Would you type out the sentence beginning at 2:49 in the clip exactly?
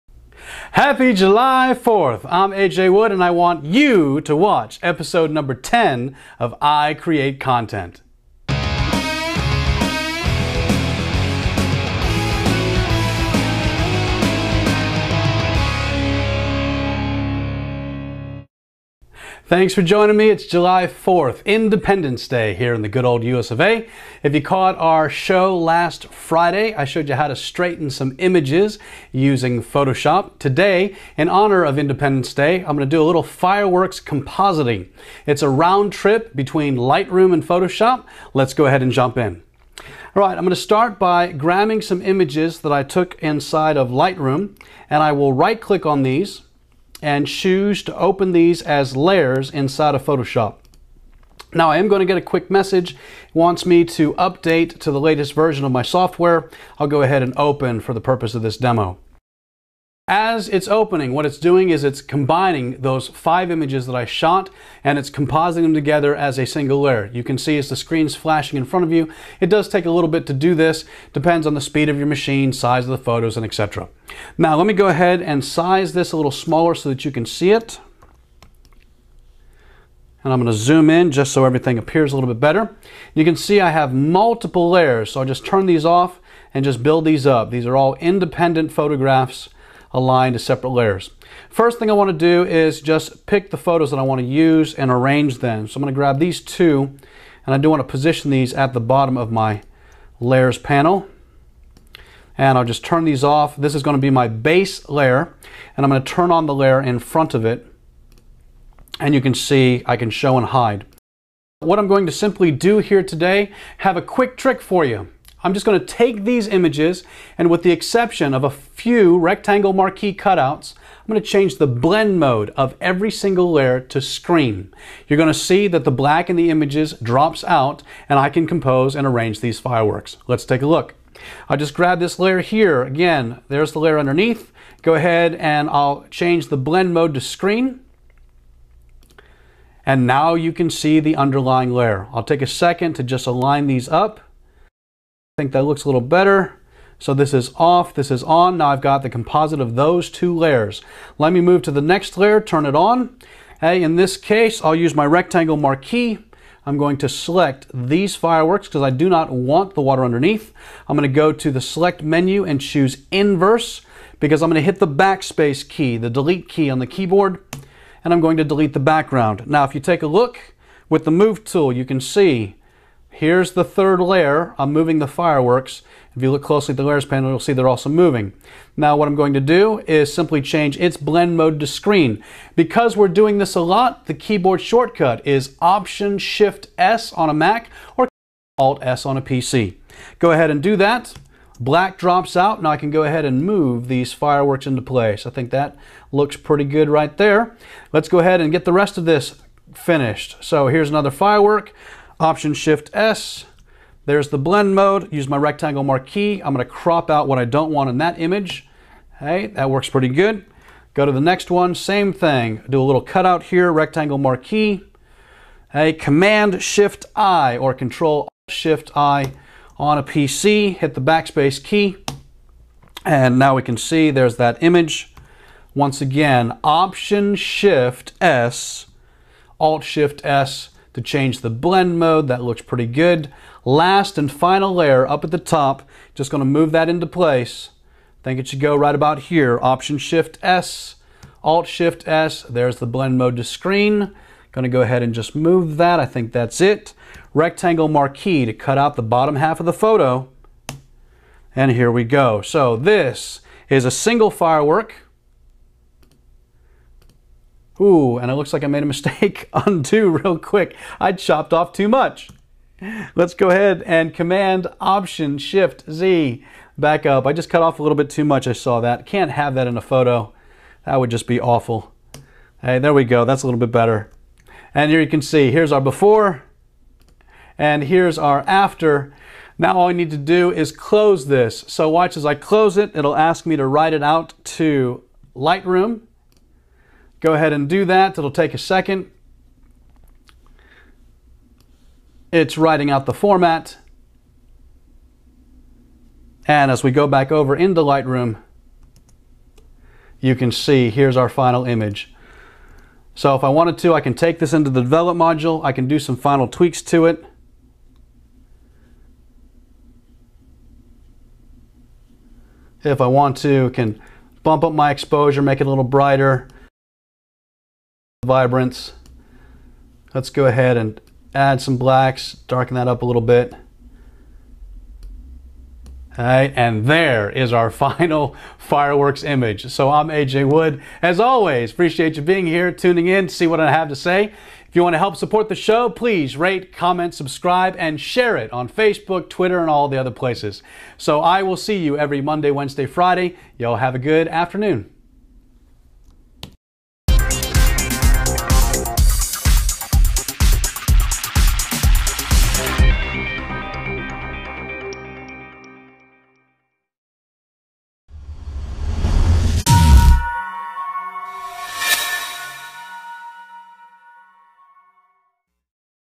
Now, if you take a look with the move tool, you can see Here's the third layer.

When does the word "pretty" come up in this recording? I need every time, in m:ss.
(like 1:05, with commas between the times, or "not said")
3:16, 3:29, 3:52.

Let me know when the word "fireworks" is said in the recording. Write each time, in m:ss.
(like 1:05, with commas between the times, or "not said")
0:33, 2:09, 2:38, 2:55, 3:14, 3:21, 4:14, 5:28.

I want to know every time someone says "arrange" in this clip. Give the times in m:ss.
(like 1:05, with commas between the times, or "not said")
1:34, 2:09.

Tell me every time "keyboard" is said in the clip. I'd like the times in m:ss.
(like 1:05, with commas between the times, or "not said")
2:46, 3:04.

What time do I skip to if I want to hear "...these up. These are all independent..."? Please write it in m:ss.
1:27.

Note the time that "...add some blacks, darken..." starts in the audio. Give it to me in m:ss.
5:21.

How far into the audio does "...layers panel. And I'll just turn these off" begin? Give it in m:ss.
1:40.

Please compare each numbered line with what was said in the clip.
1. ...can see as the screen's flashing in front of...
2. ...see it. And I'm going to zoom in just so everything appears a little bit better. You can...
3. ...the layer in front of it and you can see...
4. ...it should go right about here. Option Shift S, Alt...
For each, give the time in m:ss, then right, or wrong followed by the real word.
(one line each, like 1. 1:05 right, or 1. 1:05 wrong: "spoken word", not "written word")
1. 1:07 right
2. 1:17 right
3. 1:46 right
4. 3:58 right.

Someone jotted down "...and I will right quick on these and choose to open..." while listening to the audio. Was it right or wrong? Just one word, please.
wrong.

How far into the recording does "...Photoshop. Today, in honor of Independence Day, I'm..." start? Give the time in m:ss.
0:29.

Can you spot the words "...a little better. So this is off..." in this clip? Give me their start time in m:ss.
2:25.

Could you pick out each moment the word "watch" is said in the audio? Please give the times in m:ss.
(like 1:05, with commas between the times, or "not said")
0:04, 4:41.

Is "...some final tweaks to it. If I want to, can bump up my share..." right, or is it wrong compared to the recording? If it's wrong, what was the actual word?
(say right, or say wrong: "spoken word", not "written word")
wrong: "exposure", not "share".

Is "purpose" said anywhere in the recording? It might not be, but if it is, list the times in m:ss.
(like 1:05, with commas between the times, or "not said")
0:58.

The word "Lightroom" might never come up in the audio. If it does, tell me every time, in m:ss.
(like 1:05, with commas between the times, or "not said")
0:36, 0:43, 4:45, 4:57.